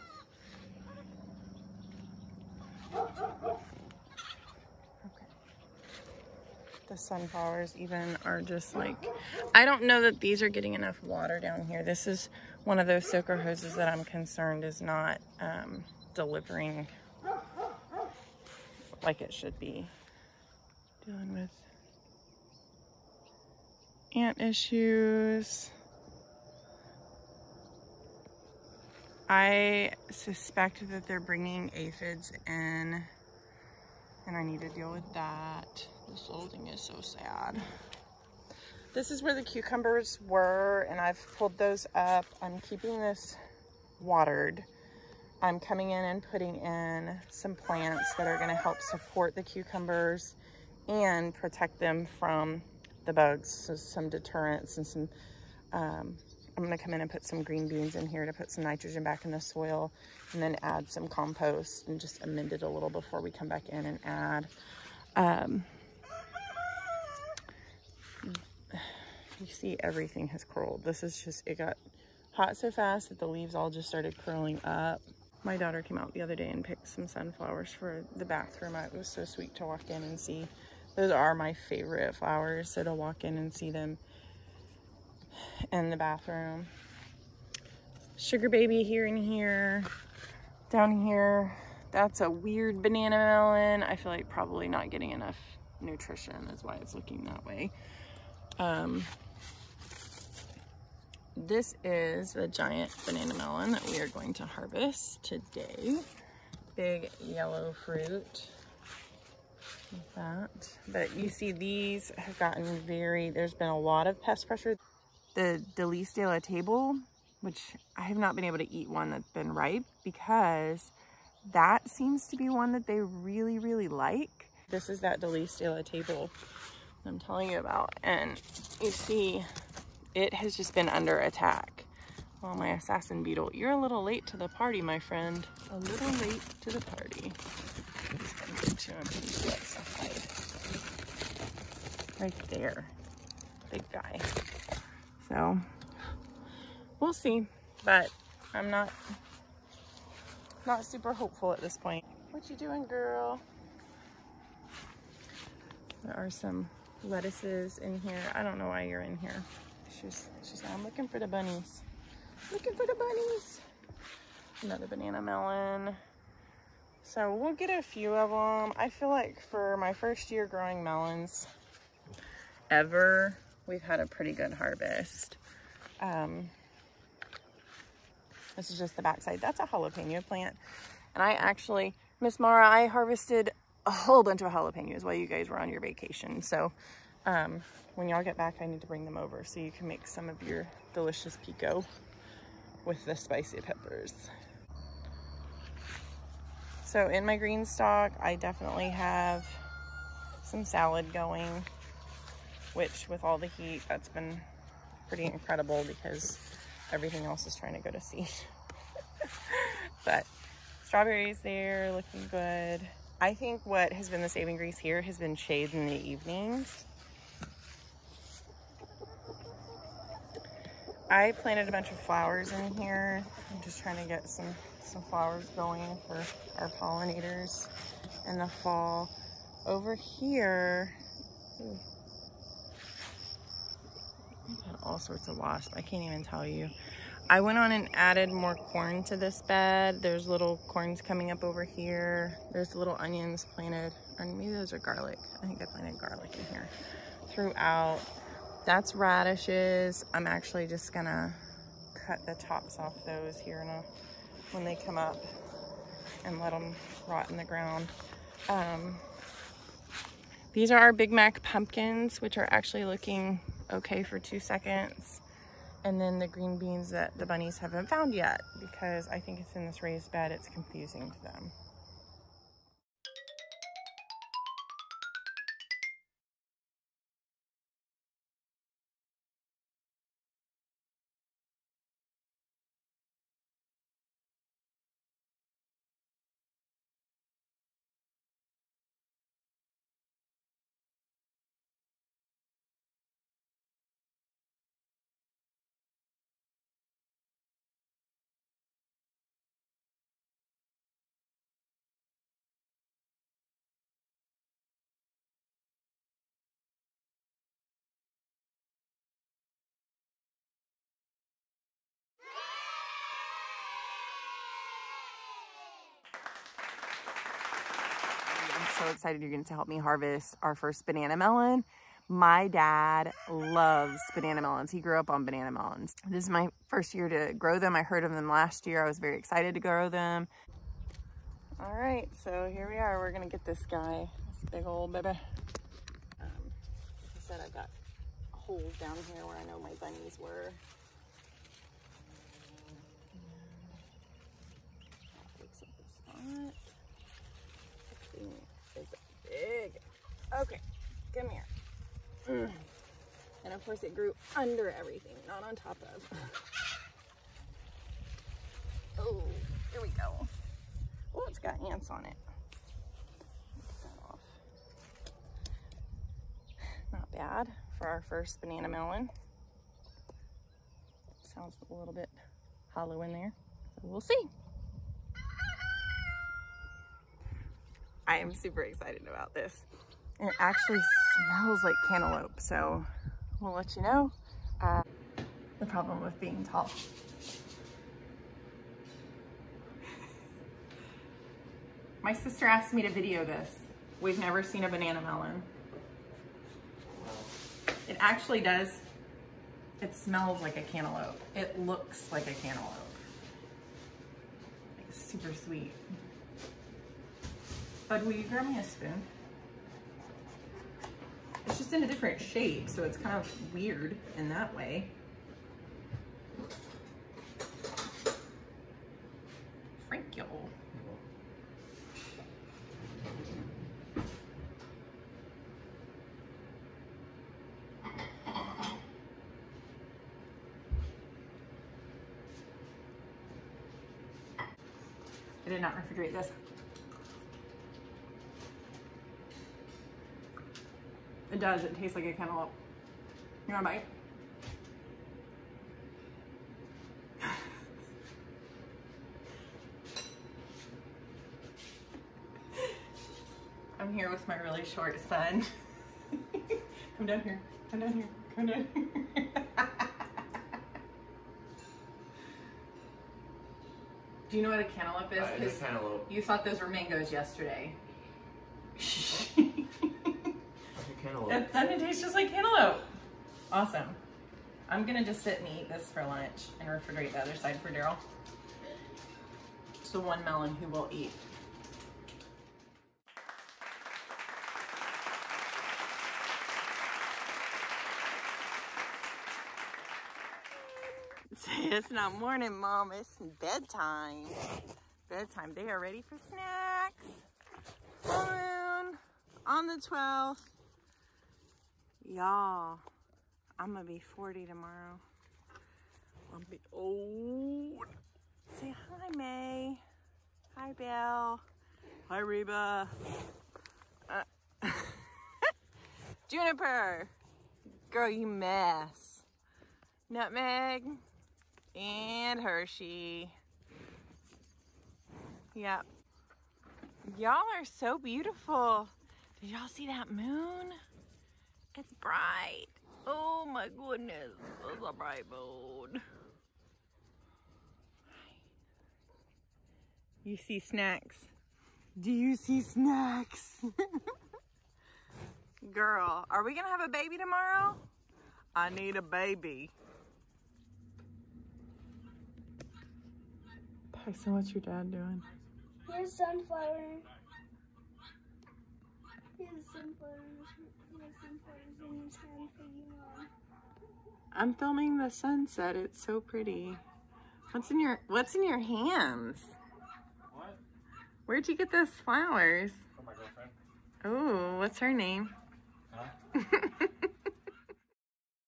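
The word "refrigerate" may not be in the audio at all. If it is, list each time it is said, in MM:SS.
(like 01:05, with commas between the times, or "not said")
07:15, 07:56.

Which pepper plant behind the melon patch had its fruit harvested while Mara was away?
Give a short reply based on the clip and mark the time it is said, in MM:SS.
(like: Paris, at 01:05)
jalapeno, at 02:59.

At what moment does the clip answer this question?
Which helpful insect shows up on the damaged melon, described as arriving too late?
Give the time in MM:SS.
02:12.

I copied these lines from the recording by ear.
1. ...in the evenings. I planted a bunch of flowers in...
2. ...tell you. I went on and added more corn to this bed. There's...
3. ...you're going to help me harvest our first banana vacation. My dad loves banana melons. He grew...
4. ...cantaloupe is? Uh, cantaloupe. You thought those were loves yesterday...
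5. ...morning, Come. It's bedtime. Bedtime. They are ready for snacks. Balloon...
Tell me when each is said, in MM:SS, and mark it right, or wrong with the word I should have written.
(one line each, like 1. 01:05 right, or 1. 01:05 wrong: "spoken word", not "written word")
1. 03:35 right
2. 03:56 right
3. 05:19 wrong: "melon", not "vacation"
4. 07:44 wrong: "mangoes", not "loves"
5. 08:12 wrong: "Mom", not "Come".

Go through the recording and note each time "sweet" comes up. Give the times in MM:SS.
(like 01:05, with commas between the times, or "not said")
01:19, 06:45.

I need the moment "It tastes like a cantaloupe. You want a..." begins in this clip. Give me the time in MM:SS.
07:21.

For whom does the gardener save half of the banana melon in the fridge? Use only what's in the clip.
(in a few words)
Daryl.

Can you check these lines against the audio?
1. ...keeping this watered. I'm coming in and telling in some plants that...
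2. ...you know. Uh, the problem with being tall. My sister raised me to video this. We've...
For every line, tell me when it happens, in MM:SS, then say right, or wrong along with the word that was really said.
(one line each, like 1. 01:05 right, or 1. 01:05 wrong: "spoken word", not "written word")
1. 00:42 wrong: "putting", not "telling"
2. 06:23 wrong: "asked", not "raised".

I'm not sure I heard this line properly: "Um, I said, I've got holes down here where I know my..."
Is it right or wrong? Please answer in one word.
right.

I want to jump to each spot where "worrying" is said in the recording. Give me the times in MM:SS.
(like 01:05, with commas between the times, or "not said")
not said.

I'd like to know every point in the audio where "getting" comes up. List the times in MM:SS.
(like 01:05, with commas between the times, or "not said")
00:10, 01:34.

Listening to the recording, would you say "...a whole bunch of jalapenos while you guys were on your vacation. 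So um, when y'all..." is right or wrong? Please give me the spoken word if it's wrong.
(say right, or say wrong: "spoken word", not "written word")
right.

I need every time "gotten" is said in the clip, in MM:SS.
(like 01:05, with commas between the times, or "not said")
01:52.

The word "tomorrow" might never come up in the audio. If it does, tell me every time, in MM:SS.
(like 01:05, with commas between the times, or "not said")
08:24, 09:07.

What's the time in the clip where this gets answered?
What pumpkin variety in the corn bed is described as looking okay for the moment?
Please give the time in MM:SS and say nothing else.
04:20.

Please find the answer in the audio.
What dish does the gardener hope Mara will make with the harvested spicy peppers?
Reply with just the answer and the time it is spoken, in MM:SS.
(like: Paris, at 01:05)
pico, at 03:11.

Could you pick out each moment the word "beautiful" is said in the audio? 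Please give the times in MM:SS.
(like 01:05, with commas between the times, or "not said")
08:47.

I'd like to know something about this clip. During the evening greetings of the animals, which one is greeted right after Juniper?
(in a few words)
Nutmeg.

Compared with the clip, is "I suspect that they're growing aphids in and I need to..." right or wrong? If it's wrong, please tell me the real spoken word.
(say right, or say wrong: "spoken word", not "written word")
wrong: "bringing", not "growing".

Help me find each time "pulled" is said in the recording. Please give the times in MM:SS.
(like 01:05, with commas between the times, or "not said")
00:41.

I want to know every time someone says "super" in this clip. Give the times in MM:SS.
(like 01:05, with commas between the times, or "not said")
02:30, 06:18, 06:44.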